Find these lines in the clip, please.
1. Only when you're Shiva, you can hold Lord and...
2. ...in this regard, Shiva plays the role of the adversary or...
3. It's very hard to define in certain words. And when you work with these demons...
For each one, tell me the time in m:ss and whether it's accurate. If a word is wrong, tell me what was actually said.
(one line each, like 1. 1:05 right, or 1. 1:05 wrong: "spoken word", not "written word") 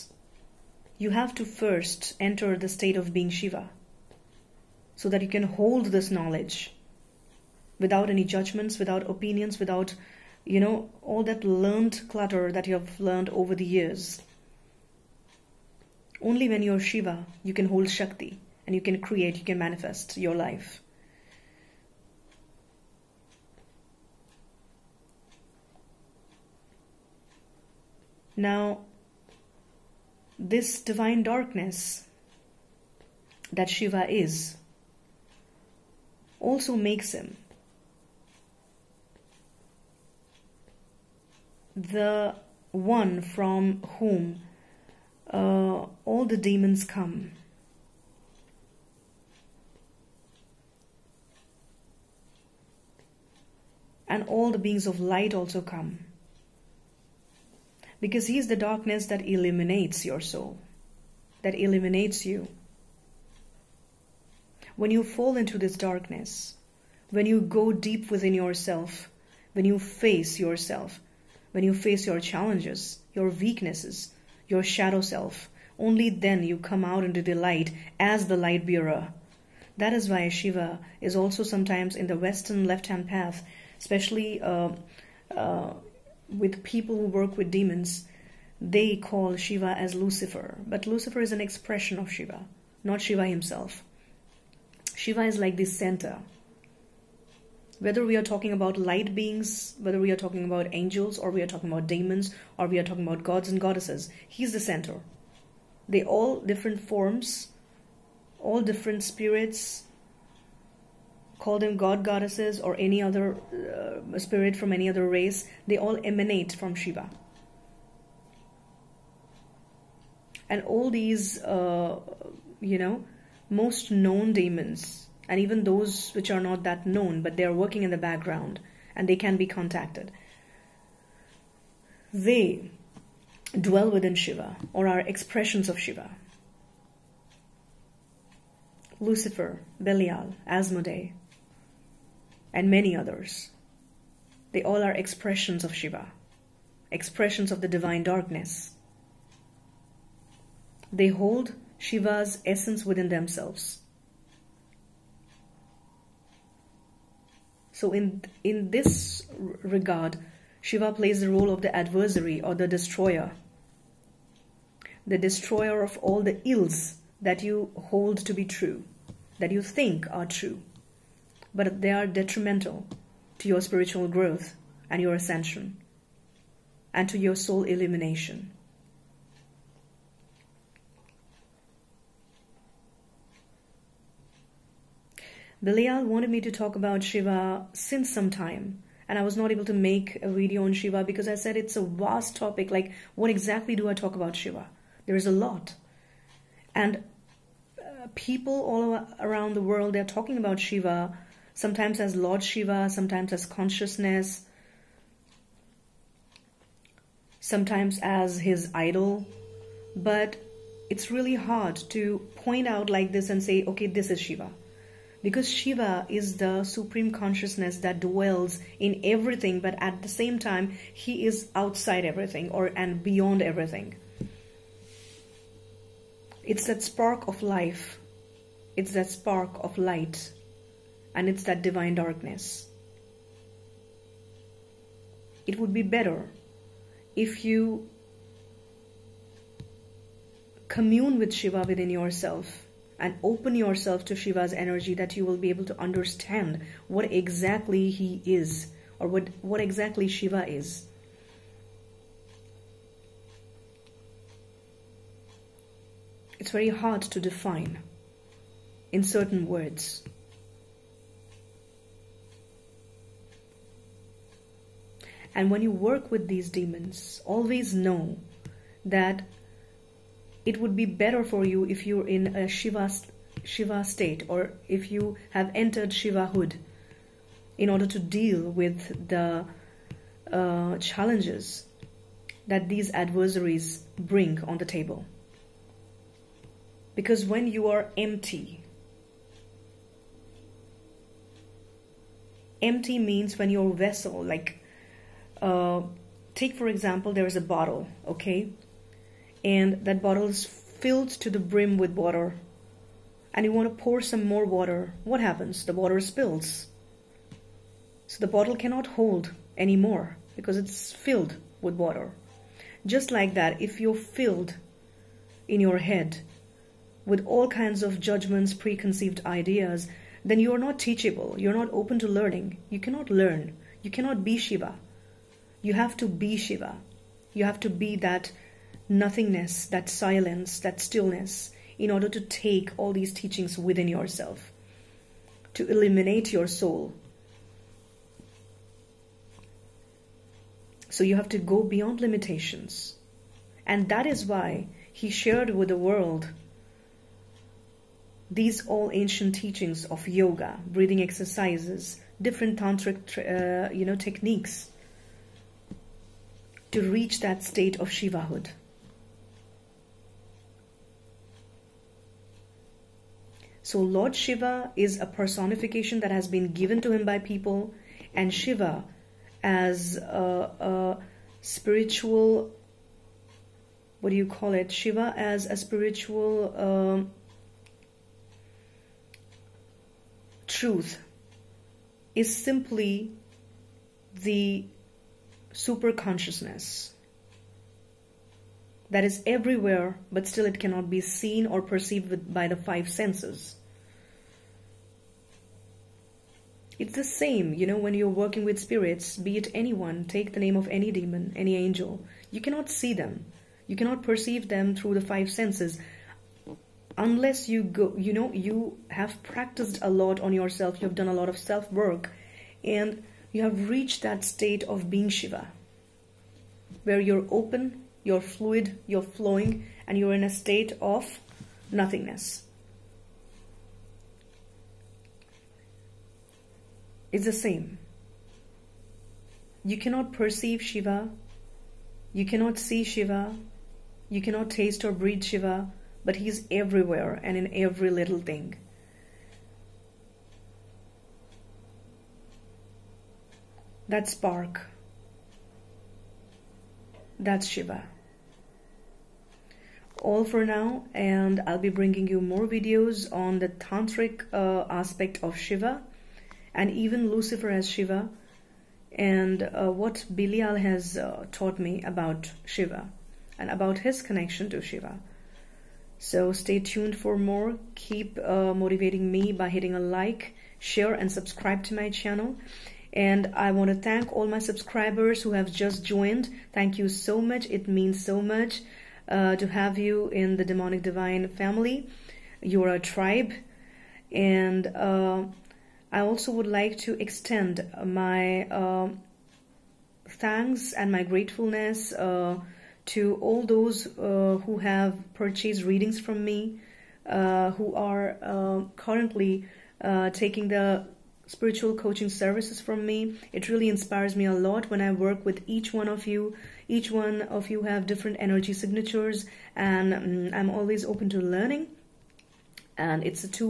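1. 0:16 wrong: "Shakti", not "Lord"
2. 2:38 right
3. 4:16 right.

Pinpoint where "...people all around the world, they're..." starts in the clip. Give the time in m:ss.
3:18.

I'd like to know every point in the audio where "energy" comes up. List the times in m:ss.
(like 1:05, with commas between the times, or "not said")
4:04, 8:28.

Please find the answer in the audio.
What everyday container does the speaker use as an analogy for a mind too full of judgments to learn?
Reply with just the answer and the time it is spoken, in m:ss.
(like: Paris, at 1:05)
A bottle, at 4:57.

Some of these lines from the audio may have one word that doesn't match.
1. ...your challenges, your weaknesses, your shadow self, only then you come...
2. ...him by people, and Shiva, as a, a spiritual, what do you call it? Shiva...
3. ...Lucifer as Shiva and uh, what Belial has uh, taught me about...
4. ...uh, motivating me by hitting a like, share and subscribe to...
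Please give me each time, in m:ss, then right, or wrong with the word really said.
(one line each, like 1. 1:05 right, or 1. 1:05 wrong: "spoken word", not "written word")
1. 1:12 right
2. 6:06 right
3. 7:37 right
4. 7:48 right.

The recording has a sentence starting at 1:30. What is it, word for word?
But Lucifer is an expression of Shiva, not Shiva himself.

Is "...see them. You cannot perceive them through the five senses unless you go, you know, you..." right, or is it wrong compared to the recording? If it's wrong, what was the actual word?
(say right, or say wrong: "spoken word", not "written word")
right.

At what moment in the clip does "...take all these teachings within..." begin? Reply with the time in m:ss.
5:32.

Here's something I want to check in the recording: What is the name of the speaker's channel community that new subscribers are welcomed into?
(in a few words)
Demonic Divine.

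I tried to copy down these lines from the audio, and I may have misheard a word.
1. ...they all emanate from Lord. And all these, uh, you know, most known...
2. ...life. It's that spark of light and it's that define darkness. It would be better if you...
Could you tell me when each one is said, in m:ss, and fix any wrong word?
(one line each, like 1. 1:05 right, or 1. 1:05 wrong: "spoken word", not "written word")
1. 1:55 wrong: "Shiva", not "Lord"
2. 3:47 wrong: "divine", not "define".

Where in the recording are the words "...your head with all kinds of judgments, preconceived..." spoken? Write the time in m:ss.
5:15.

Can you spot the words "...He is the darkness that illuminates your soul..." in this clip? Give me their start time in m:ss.
0:58.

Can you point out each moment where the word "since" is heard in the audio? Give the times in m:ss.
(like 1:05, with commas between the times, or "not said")
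3:07.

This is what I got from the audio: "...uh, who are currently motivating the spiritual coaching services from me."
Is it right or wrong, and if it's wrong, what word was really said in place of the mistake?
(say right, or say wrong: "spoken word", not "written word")
wrong: "taking", not "motivating".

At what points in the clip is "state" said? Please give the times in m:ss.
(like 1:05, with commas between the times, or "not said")
0:02, 4:33, 5:57, 6:54, 7:00.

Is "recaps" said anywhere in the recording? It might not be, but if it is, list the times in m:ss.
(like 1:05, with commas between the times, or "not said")
not said.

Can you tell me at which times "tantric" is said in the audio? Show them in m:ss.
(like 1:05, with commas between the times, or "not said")
5:52, 7:33.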